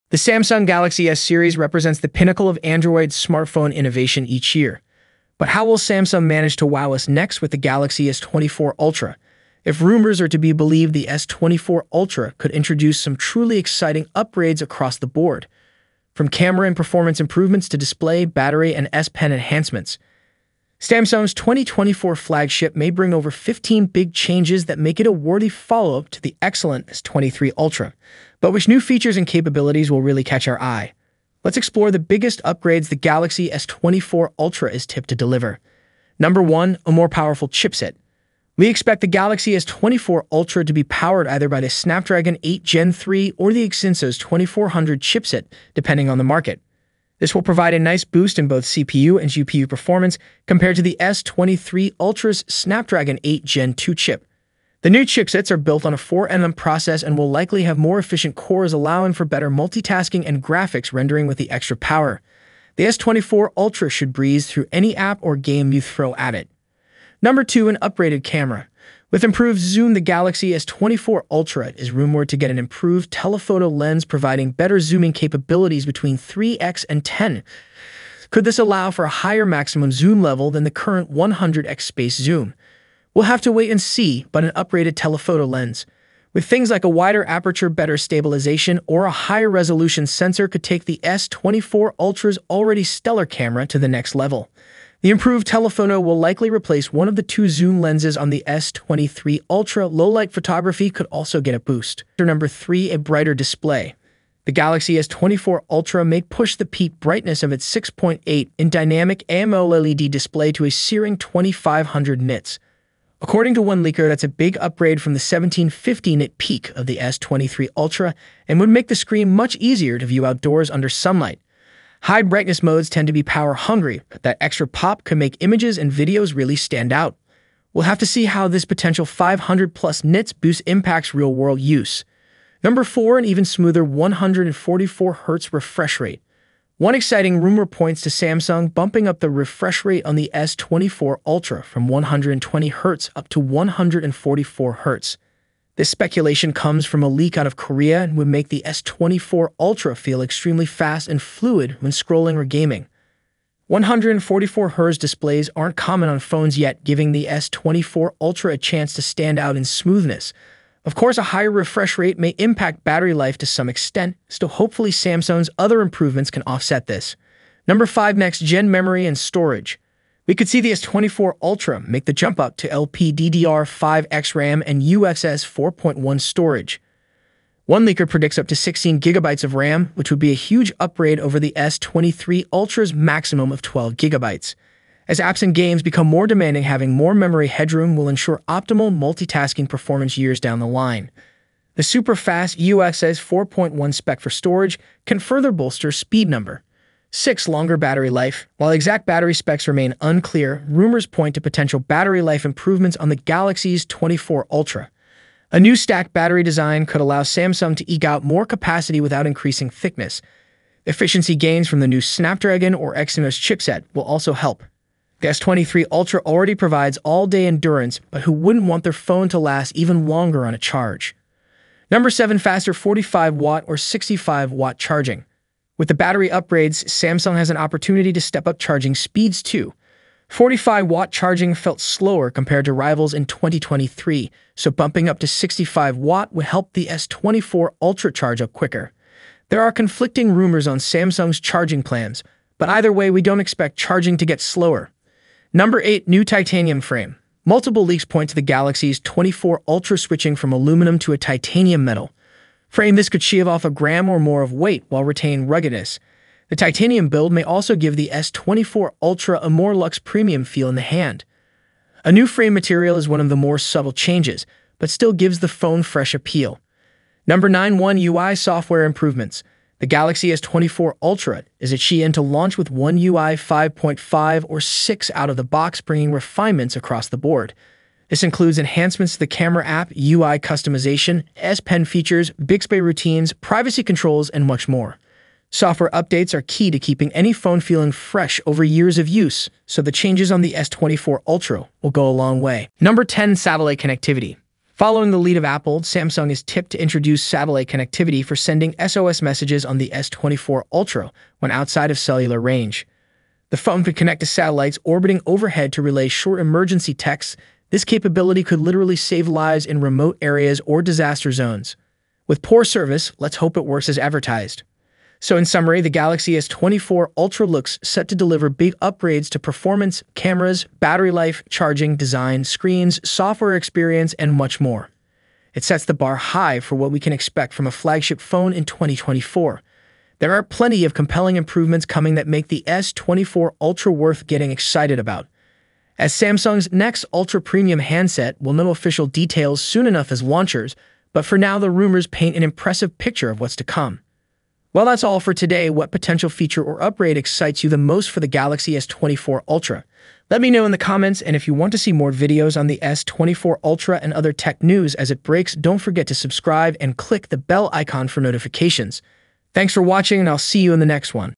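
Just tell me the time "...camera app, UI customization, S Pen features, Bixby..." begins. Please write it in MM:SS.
04:39.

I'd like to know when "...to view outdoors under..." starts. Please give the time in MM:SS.
01:59.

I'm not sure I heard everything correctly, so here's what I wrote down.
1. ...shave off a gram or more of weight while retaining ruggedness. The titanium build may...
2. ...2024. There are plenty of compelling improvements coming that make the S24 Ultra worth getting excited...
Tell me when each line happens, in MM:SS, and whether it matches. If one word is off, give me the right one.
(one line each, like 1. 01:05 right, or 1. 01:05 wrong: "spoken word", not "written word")
1. 04:13 right
2. 05:28 right.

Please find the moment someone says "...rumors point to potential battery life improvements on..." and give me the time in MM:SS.
03:20.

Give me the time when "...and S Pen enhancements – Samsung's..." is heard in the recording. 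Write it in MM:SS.
00:18.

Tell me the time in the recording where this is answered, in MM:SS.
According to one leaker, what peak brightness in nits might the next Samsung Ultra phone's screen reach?
01:51.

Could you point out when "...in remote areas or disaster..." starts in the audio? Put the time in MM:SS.
05:09.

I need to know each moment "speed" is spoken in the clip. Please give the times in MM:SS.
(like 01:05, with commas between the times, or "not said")
03:15, 03:48.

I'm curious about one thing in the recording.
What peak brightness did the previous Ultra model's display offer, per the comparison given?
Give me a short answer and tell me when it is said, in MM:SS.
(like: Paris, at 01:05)
1750 nits, at 01:55.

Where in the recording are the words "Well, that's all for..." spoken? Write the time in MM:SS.
05:44.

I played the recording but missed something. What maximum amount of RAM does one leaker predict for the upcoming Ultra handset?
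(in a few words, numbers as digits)
16 gigabytes.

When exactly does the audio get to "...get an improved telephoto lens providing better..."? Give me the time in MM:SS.
01:12.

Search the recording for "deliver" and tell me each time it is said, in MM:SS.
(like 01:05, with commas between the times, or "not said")
00:35, 05:18.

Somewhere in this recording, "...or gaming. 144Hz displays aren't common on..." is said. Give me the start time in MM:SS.
02:32.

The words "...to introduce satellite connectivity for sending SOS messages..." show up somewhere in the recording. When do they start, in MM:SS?
04:56.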